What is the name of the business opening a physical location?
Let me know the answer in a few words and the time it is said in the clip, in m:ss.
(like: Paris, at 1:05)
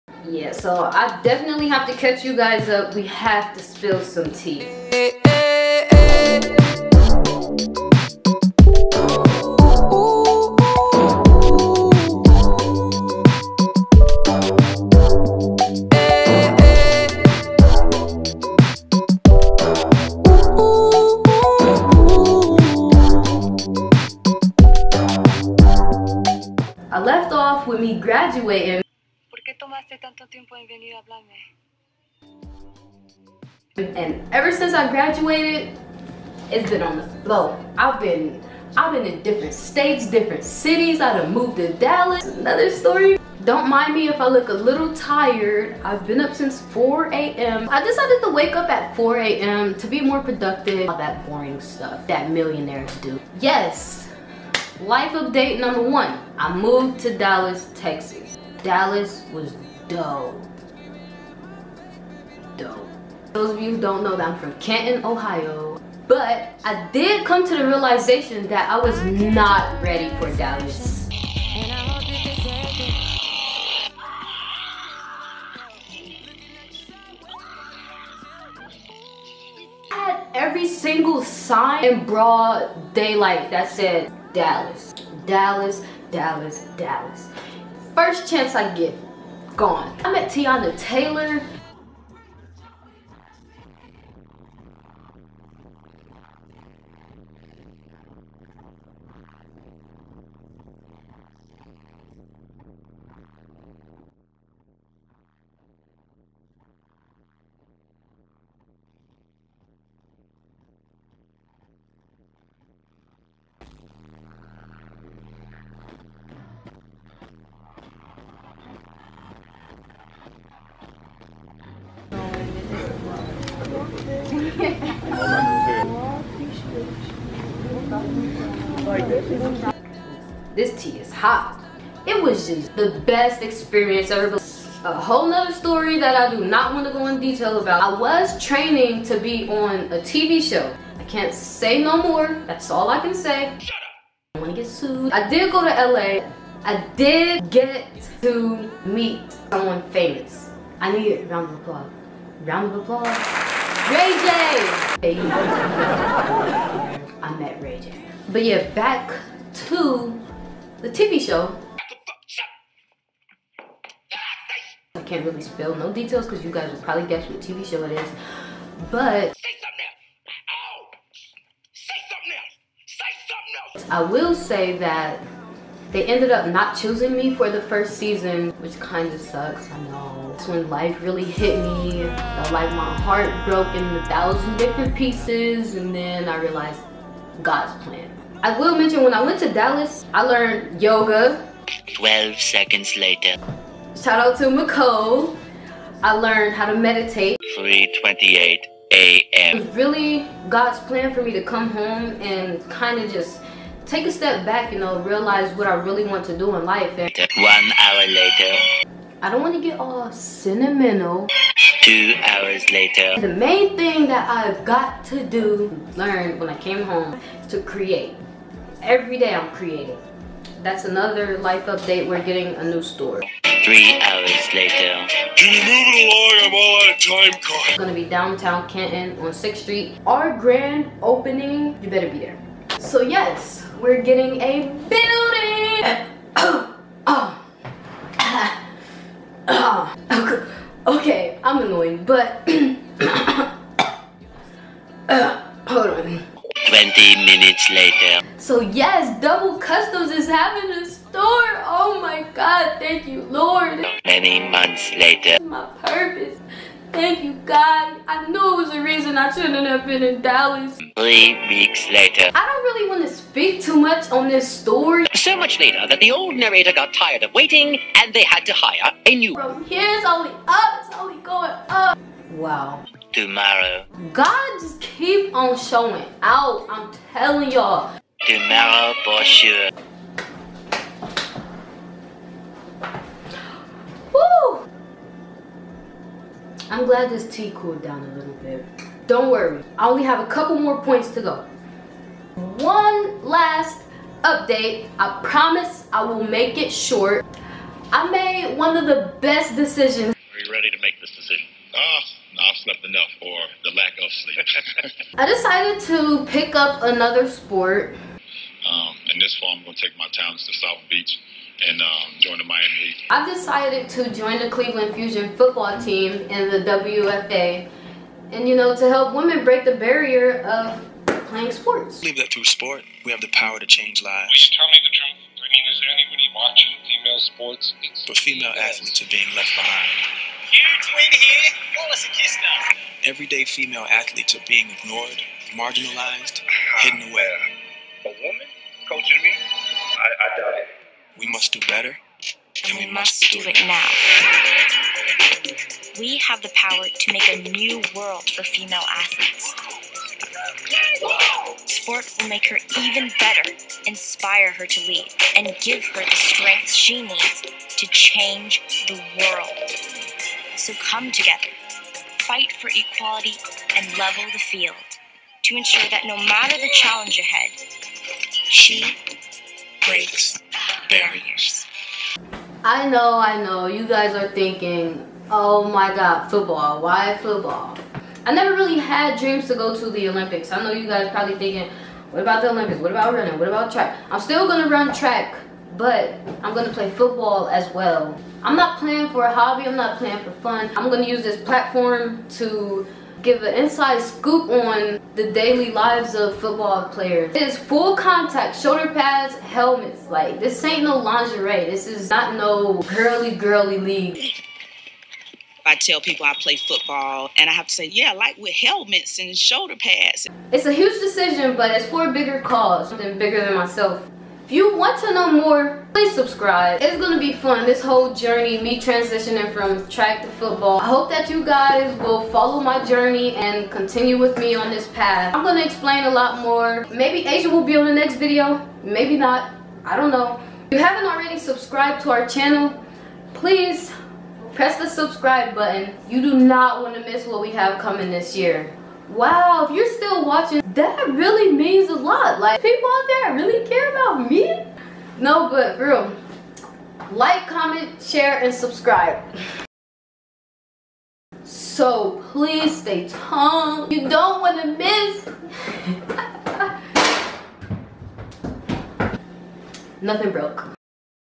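Double Customs, at 4:09.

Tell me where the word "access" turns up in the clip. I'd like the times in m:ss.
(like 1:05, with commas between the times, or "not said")
not said.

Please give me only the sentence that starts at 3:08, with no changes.
I will mention when I went to Dallas, I learned yoga.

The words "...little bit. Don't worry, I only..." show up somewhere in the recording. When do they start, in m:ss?
4:48.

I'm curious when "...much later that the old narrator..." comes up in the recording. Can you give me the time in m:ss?
4:25.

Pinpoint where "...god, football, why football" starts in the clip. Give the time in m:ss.
6:15.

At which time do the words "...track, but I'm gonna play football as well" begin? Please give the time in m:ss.
6:24.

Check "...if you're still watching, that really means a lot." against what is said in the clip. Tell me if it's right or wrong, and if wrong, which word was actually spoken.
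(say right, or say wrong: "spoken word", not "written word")
right.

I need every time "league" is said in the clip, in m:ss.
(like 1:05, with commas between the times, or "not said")
6:43.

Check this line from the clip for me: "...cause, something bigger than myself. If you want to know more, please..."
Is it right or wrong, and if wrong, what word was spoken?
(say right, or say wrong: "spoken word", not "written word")
right.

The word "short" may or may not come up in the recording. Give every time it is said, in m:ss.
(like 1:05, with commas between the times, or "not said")
4:56.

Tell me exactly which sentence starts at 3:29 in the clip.
I don't want to get all sentimental.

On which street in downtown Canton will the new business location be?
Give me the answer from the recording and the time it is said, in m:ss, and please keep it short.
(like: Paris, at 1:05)
6th Street, at 3:49.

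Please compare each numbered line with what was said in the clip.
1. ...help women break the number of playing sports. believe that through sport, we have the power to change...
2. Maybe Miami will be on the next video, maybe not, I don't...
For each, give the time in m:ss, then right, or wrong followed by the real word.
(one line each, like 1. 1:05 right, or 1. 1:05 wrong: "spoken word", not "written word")
1. 5:18 wrong: "barrier", not "number"
2. 7:06 wrong: "Aziah", not "Miami".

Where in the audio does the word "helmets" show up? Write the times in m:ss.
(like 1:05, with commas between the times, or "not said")
6:39, 6:48.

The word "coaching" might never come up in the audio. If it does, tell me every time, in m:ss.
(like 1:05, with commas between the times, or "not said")
5:38.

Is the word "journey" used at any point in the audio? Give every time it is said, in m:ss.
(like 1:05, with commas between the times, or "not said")
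6:58, 7:02.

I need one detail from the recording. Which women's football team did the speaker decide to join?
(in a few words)
Cleveland Fusion.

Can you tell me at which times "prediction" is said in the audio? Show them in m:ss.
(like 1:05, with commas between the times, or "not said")
not said.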